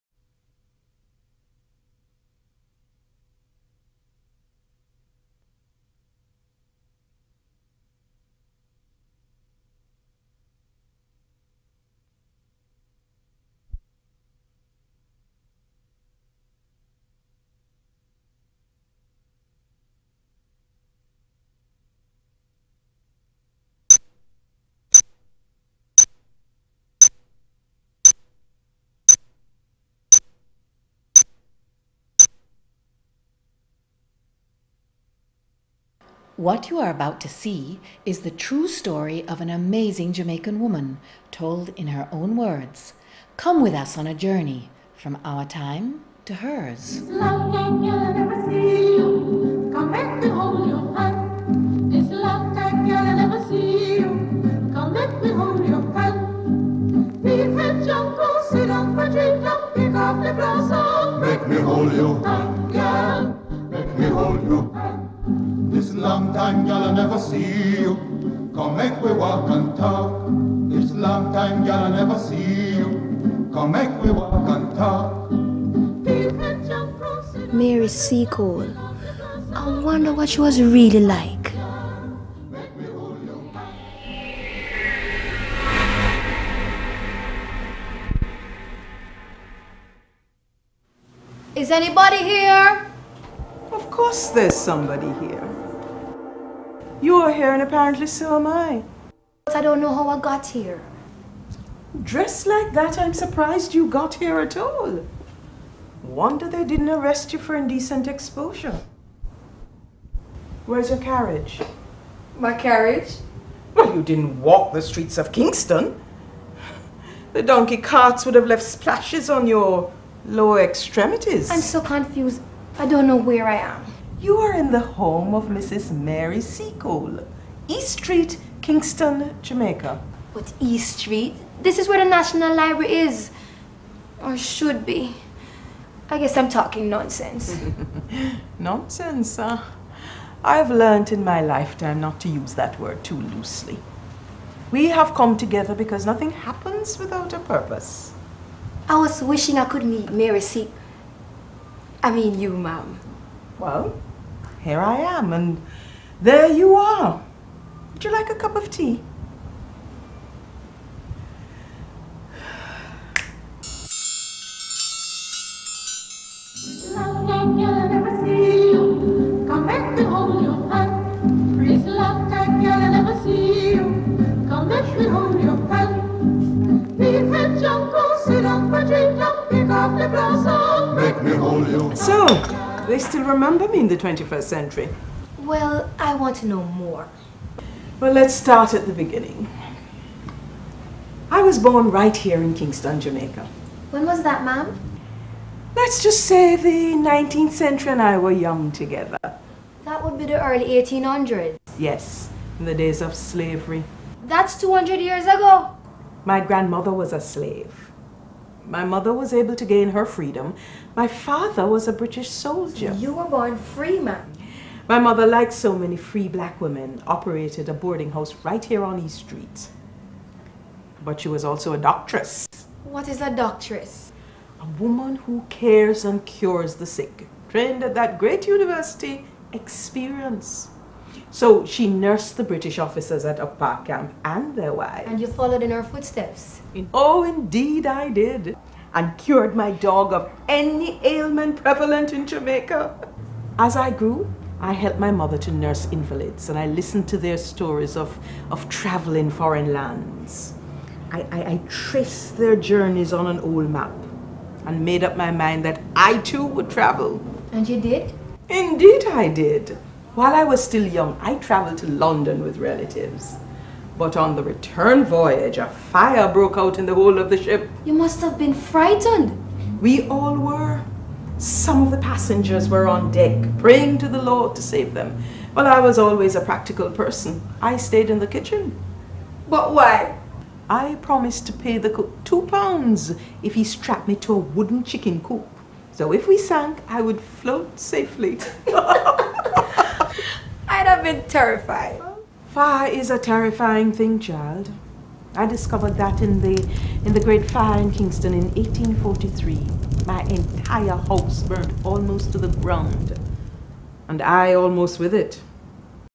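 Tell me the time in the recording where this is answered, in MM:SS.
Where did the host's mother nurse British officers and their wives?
03:53.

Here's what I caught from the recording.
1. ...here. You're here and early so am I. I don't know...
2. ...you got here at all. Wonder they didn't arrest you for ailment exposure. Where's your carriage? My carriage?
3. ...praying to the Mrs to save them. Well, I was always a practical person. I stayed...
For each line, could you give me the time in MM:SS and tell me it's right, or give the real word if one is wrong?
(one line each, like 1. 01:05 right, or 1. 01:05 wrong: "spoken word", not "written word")
1. 01:35 wrong: "apparently", not "early"
2. 01:43 wrong: "indecent", not "ailment"
3. 04:33 wrong: "Lord", not "Mrs".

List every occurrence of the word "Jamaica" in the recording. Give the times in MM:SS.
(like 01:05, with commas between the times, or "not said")
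02:09, 03:12, 04:02.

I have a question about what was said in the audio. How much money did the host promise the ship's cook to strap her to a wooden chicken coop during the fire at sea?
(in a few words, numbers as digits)
2 pounds.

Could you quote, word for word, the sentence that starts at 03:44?
A woman who cares and cures the sick, trained at that great university, experience.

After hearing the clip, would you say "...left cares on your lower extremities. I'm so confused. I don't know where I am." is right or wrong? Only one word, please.
wrong.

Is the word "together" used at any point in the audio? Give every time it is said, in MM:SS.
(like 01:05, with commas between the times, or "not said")
02:25, 03:18.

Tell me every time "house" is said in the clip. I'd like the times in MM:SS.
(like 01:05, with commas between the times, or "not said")
03:38, 05:00.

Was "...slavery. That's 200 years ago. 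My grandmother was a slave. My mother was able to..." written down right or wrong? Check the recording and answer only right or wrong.
right.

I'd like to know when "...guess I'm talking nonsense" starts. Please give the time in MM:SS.
02:16.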